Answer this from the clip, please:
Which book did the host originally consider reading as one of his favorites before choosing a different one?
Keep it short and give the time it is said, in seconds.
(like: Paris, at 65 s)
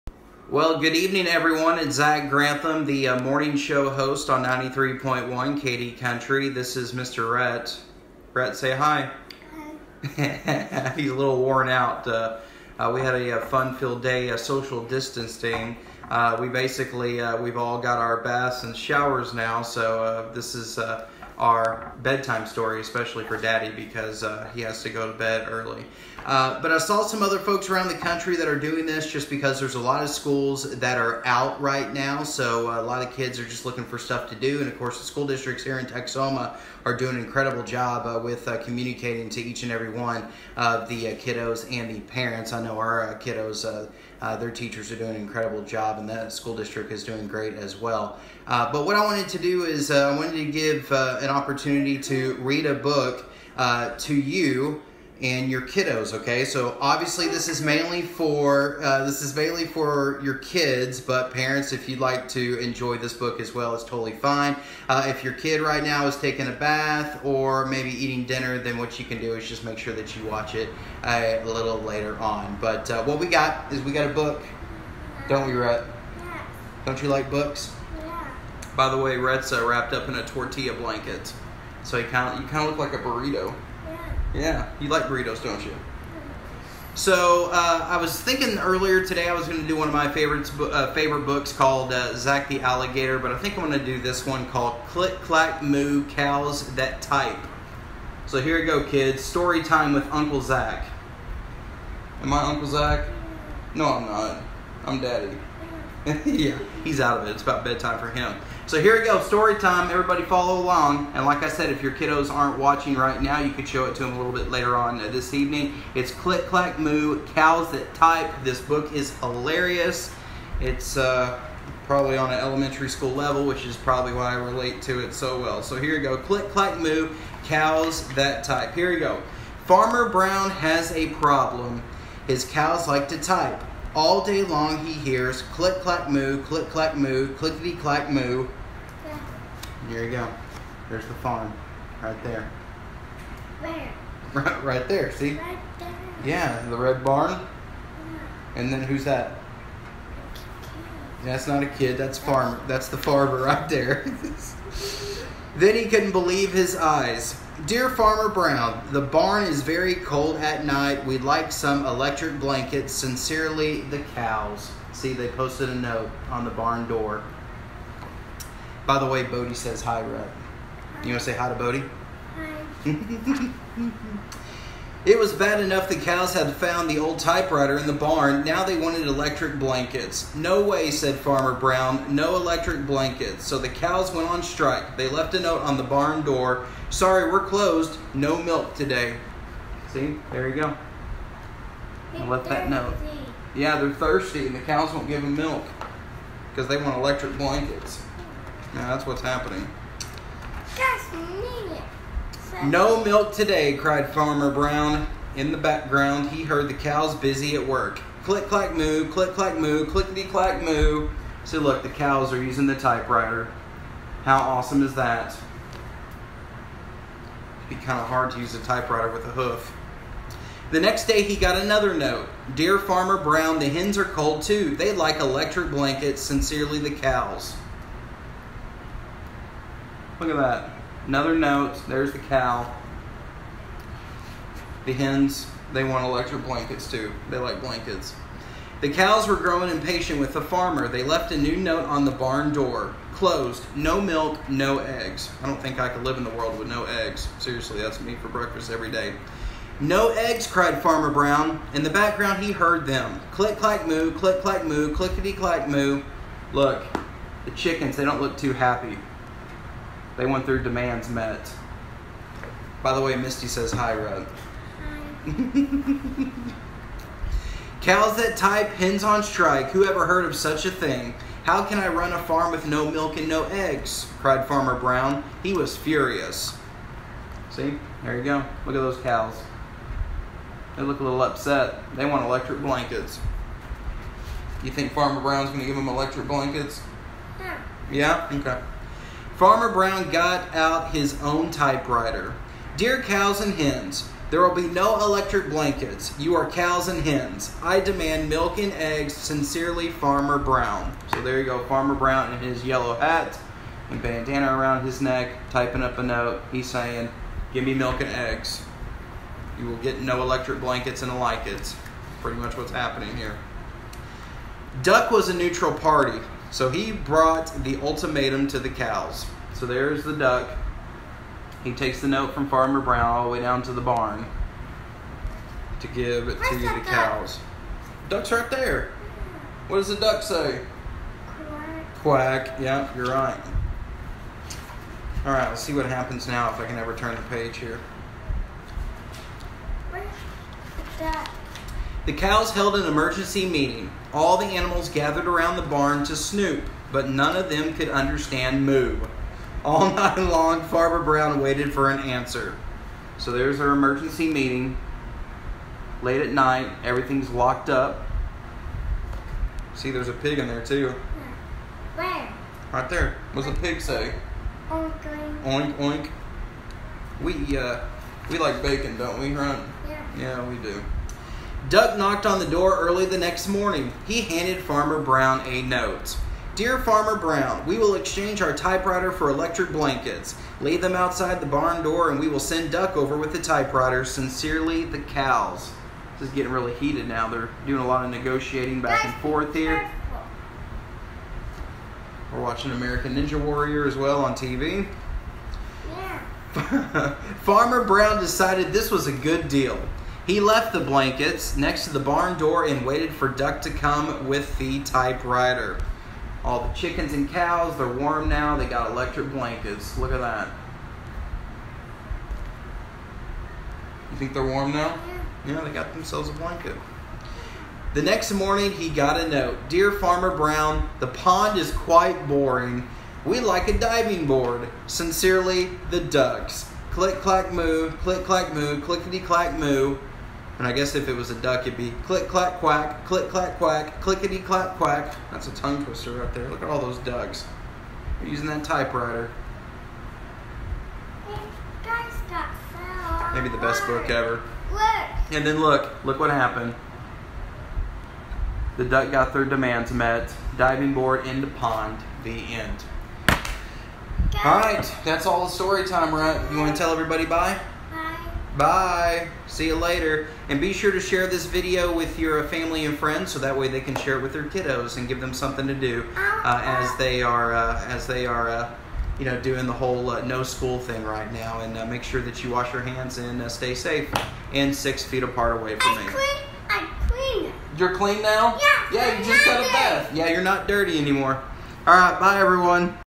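Zach the Alligator, at 92 s.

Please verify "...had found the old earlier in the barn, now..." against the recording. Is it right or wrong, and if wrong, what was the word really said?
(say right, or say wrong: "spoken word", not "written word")
wrong: "typewriter", not "earlier".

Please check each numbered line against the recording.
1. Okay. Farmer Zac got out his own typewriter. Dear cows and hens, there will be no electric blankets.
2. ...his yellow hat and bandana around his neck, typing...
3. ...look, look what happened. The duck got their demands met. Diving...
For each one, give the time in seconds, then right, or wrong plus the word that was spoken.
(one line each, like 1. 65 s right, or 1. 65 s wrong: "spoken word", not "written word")
1. 288 s wrong: "Brown", not "Zac"
2. 302 s right
3. 445 s right.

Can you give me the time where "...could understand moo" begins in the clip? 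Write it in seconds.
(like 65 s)
347 s.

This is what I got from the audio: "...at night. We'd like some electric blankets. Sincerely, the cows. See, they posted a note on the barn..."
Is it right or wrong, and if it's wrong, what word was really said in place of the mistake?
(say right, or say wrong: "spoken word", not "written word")
right.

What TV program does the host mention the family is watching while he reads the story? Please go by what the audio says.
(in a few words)
American Ninja Warrior.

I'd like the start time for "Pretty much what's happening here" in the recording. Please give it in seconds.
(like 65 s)
312 s.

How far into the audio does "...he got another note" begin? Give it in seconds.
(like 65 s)
221 s.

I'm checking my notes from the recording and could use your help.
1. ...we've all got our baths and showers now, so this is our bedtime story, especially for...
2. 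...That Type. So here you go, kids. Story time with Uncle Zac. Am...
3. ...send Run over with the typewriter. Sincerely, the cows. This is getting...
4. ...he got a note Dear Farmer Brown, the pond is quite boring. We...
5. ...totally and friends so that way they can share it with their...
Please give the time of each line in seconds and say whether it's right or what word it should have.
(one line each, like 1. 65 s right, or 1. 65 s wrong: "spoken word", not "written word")
1. 17 s right
2. 96 s right
3. 382 s wrong: "Duck", not "Run"
4. 418 s right
5. 462 s wrong: "family", not "totally".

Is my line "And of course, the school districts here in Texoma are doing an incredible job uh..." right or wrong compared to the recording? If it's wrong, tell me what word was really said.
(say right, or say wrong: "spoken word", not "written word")
right.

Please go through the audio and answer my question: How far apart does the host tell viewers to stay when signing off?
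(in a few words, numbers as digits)
6 feet.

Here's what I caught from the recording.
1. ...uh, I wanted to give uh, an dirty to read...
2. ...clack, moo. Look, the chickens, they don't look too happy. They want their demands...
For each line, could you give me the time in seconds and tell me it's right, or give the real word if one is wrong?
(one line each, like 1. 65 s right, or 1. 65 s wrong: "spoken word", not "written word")
1. 49 s wrong: "opportunity", not "dirty"
2. 255 s right.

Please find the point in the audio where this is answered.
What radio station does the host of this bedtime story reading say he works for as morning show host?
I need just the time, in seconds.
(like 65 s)
4 s.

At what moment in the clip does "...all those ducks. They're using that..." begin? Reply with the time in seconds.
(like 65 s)
436 s.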